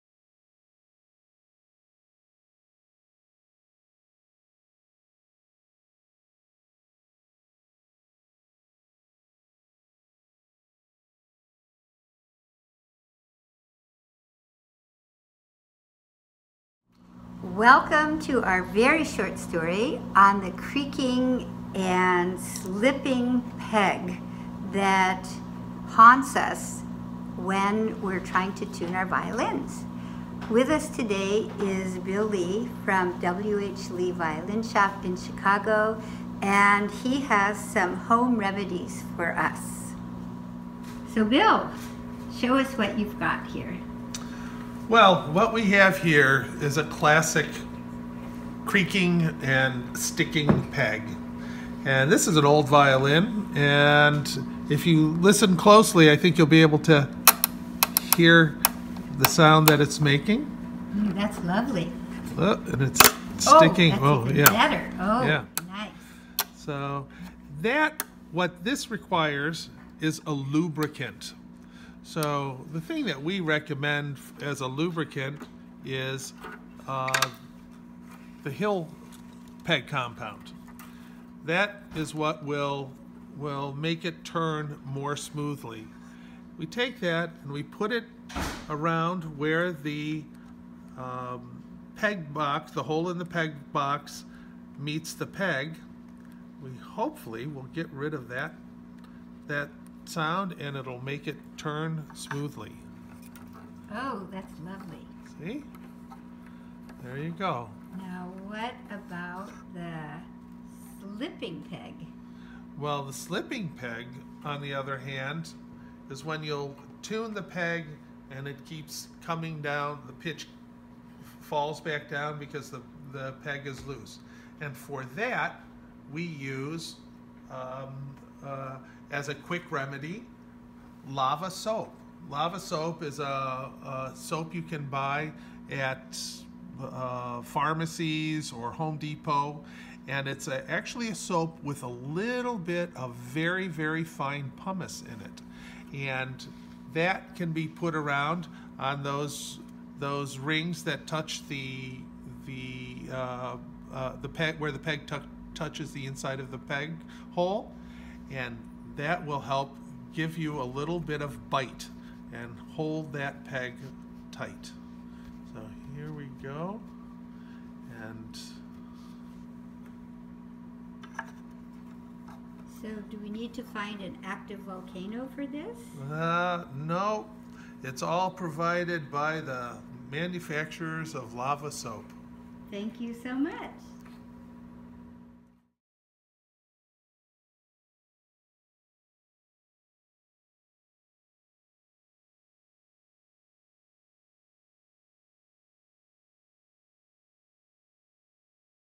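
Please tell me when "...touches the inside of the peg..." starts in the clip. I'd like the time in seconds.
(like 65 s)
155 s.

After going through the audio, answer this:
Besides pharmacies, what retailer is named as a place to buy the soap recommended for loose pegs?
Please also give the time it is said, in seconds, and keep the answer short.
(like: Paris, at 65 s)
Home Depot, at 138 s.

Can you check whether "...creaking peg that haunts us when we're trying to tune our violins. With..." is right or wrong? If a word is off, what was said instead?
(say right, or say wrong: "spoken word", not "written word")
wrong: "slipping", not "creaking".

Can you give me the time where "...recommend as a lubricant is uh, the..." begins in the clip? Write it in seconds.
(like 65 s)
73 s.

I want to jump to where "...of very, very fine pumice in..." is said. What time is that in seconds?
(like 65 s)
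142 s.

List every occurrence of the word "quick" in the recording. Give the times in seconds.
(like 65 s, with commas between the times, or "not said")
129 s.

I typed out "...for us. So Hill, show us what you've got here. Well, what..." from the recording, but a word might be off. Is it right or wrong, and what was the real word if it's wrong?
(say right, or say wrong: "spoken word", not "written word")
wrong: "Bill", not "Hill".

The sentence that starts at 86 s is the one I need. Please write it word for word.
We take that and we put it around where the um, peg box, the hole in the peg box meets the peg.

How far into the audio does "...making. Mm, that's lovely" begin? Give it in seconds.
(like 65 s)
60 s.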